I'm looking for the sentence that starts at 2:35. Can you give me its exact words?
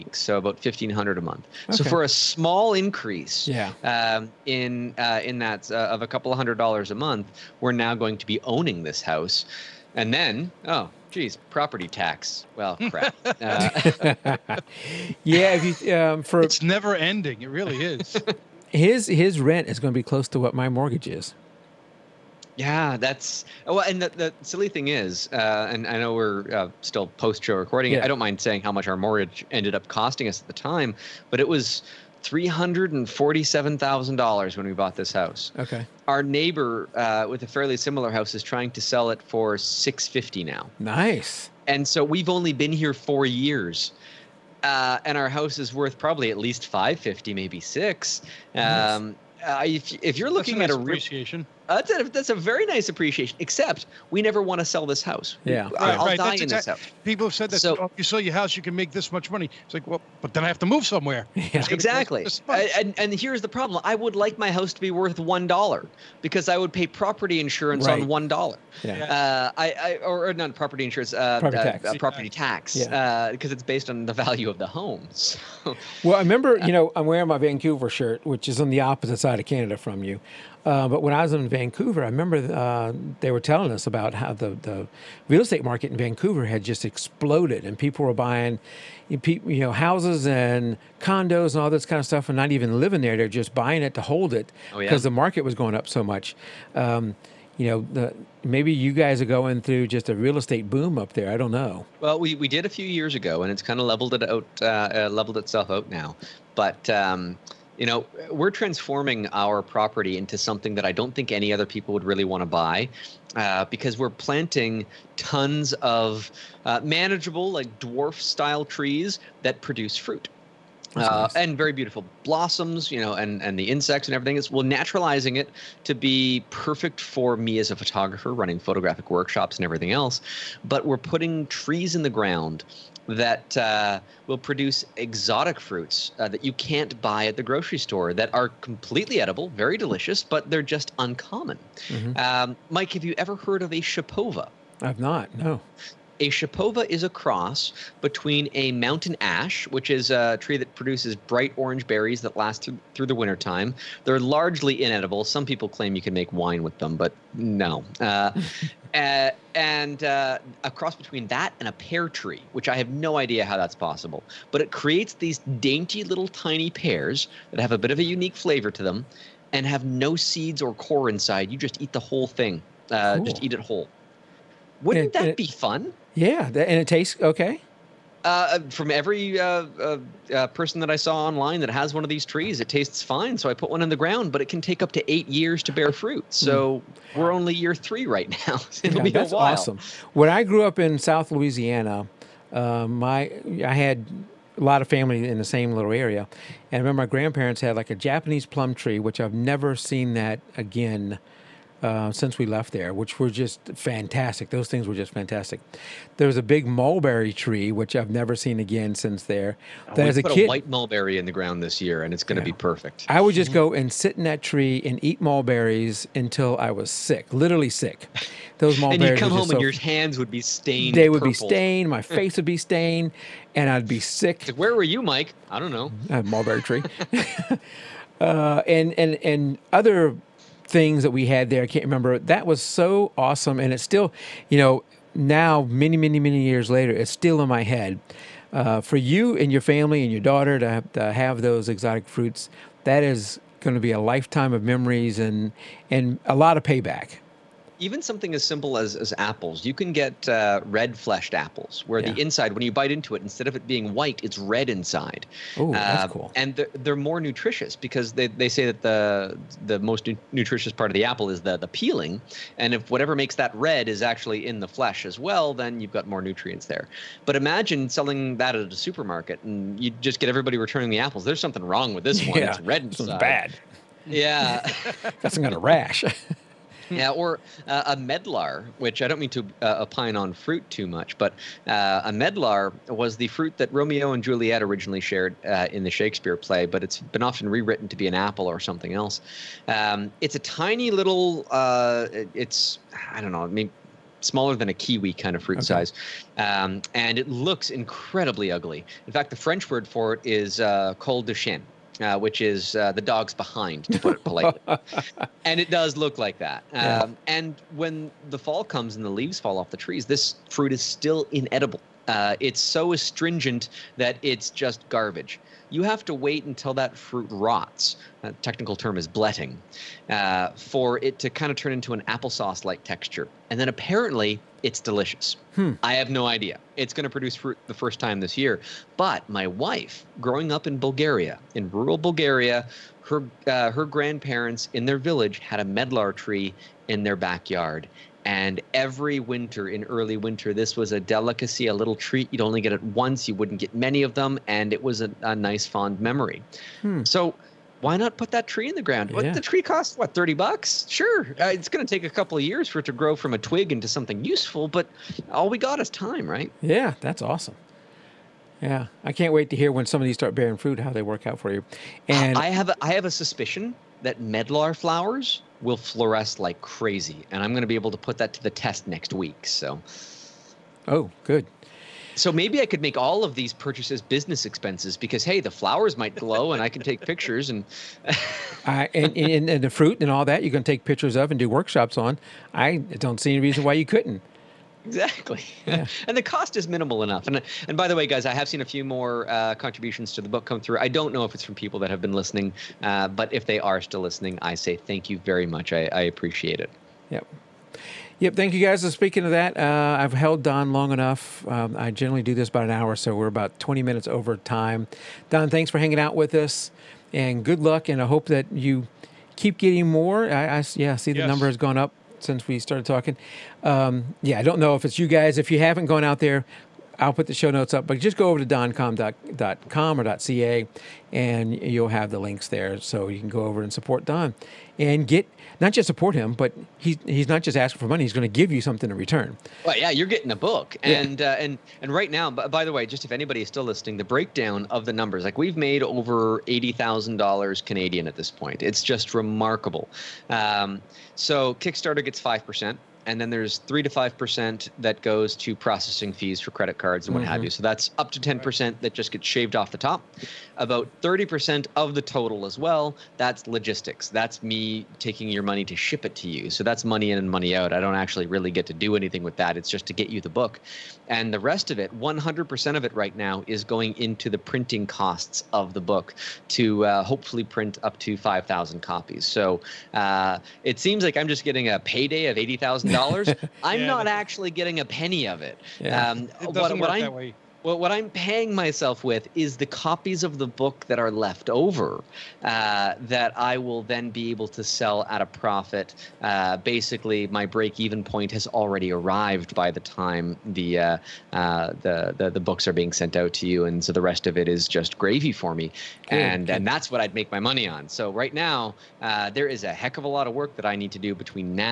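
Some people claim you can make wine with them, but no.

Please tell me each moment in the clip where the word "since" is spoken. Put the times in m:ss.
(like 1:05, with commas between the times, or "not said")
3:22, 3:28, 6:52.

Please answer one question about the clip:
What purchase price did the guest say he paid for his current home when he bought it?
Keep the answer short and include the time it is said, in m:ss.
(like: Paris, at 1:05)
$347,000, at 0:32.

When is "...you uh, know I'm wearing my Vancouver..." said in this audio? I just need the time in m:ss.
1:16.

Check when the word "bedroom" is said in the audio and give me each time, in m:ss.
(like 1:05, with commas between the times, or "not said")
not said.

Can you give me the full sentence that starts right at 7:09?
Well, yeah, you're getting a book.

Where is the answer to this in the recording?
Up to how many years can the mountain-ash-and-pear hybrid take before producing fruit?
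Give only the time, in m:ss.
3:05.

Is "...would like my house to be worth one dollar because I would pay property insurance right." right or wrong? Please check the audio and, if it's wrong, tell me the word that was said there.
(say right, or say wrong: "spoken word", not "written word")
right.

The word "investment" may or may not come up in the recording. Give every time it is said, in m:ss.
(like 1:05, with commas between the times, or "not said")
not said.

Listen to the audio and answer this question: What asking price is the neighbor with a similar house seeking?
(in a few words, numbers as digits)
650.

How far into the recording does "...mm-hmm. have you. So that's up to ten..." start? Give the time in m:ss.
7:27.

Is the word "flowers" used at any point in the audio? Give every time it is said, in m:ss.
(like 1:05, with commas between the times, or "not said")
6:04, 6:15.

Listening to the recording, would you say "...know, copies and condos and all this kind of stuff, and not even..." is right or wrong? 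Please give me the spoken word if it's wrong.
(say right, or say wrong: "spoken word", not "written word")
wrong: "houses", not "copies".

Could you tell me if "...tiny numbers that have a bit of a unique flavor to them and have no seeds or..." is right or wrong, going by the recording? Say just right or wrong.
wrong.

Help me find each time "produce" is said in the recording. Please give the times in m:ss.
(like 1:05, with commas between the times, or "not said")
1:59, 2:14, 2:30, 5:27.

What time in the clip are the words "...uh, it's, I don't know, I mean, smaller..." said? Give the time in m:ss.
4:51.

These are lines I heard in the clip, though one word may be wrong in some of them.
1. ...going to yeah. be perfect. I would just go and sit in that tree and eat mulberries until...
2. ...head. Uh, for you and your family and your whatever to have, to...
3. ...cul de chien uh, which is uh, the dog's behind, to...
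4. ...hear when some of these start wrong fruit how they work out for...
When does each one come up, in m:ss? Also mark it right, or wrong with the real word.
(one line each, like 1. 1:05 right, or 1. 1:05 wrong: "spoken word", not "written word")
1. 3:32 right
2. 3:57 wrong: "daughter", not "whatever"
3. 5:00 right
4. 5:59 wrong: "bearing", not "wrong".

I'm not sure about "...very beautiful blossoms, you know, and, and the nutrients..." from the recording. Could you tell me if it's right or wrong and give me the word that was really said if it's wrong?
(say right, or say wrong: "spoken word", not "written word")
wrong: "insects", not "nutrients".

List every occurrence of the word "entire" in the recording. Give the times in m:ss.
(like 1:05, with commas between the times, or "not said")
not said.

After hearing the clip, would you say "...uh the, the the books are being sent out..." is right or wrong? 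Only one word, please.
right.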